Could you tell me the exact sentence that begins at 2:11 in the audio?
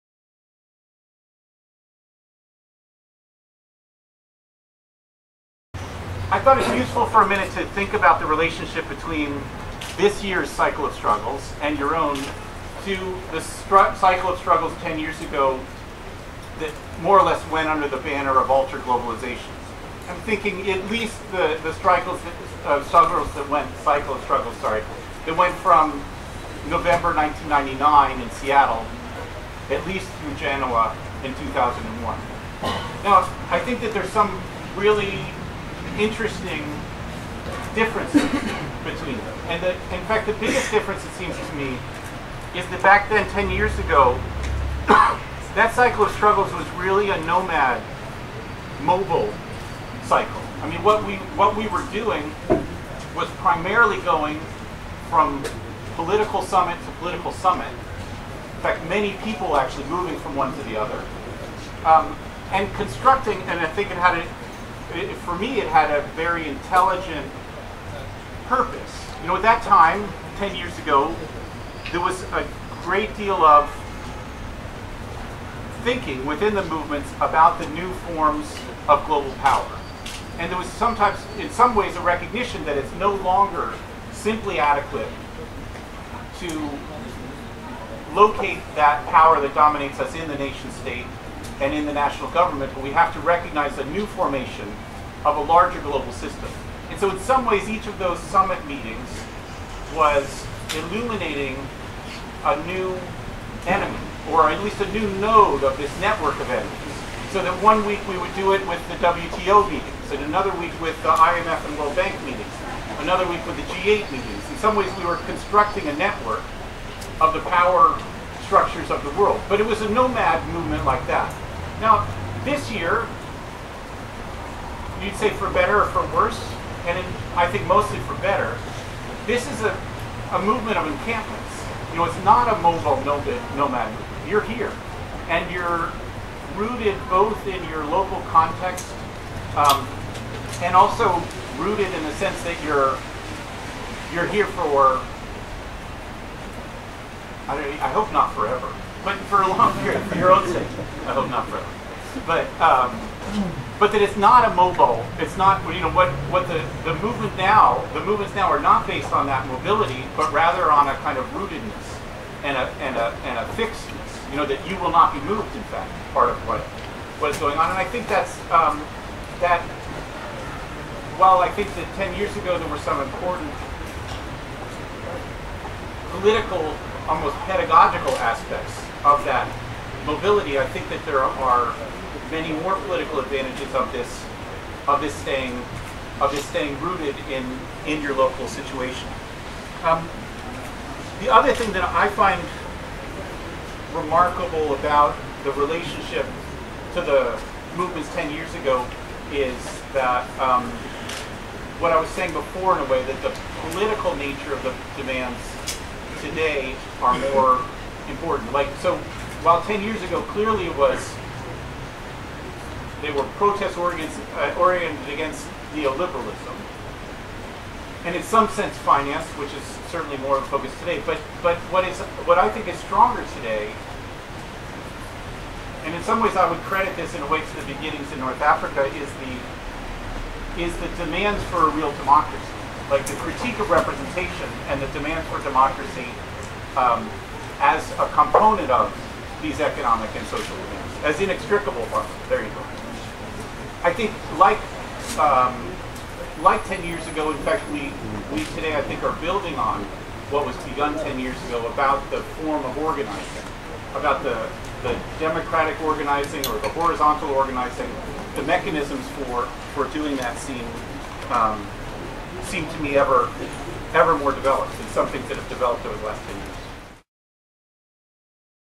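You know, it's not a mobile nomad, movement.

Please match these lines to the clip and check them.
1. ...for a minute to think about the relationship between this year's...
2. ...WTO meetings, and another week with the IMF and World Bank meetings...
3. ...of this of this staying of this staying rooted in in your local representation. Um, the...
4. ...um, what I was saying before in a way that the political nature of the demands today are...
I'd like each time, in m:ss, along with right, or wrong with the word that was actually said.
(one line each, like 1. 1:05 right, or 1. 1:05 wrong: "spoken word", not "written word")
1. 0:07 right
2. 1:48 right
3. 3:03 wrong: "situation", not "representation"
4. 3:20 right.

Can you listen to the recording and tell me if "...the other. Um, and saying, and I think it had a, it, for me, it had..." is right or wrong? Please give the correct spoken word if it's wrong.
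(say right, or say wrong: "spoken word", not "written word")
wrong: "constructing", not "saying".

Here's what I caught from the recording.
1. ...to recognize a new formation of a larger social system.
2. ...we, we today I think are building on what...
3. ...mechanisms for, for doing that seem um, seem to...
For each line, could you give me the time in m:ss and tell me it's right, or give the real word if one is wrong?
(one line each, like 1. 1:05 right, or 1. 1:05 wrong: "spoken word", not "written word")
1. 1:33 wrong: "global", not "social"
2. 4:07 right
3. 4:18 right.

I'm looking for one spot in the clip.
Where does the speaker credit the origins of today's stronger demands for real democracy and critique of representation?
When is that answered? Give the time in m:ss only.
3:48.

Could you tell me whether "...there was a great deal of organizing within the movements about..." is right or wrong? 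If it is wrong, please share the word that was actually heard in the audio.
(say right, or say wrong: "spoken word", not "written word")
wrong: "thinking", not "organizing".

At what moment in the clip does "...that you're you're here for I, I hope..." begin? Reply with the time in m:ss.
2:22.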